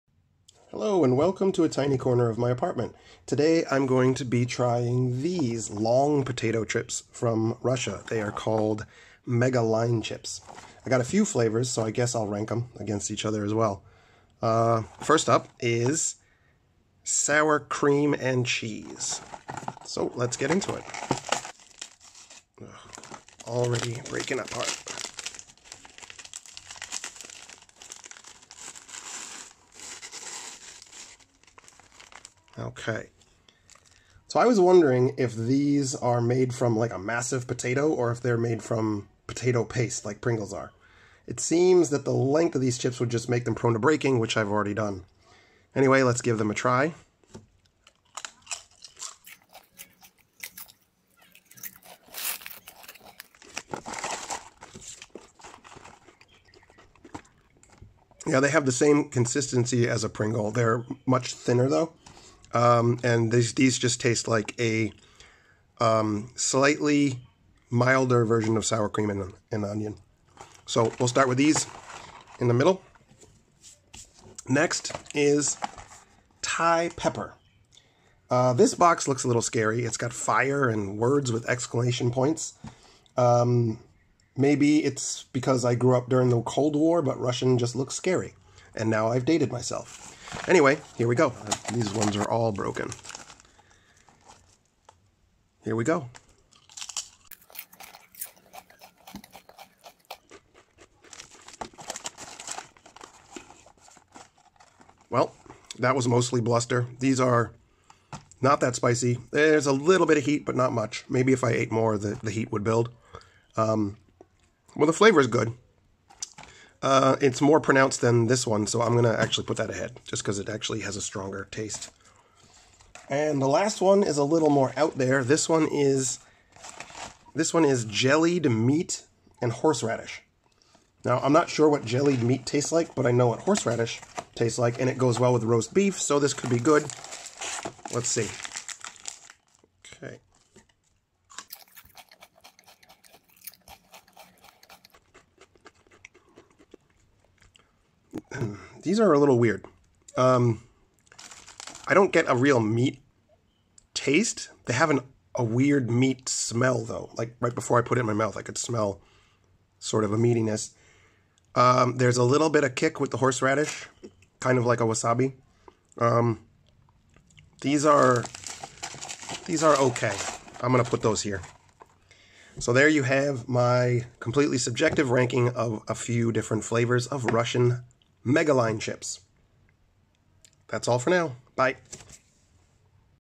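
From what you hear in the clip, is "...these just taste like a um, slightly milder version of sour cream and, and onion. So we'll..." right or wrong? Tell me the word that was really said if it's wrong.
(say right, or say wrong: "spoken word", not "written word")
right.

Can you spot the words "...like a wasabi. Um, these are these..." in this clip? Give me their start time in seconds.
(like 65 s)
164 s.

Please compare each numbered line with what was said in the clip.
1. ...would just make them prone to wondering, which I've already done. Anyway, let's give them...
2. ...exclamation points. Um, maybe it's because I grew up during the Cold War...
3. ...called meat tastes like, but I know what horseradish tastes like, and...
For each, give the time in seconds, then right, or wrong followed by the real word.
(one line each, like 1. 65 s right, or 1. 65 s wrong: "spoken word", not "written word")
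1. 42 s wrong: "breaking", not "wondering"
2. 81 s right
3. 131 s wrong: "jellied", not "called".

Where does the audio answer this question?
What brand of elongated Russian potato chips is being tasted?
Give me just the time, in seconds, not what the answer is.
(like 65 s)
9 s.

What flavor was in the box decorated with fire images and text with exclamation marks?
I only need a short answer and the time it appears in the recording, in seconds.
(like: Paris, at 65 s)
Thai pepper, at 76 s.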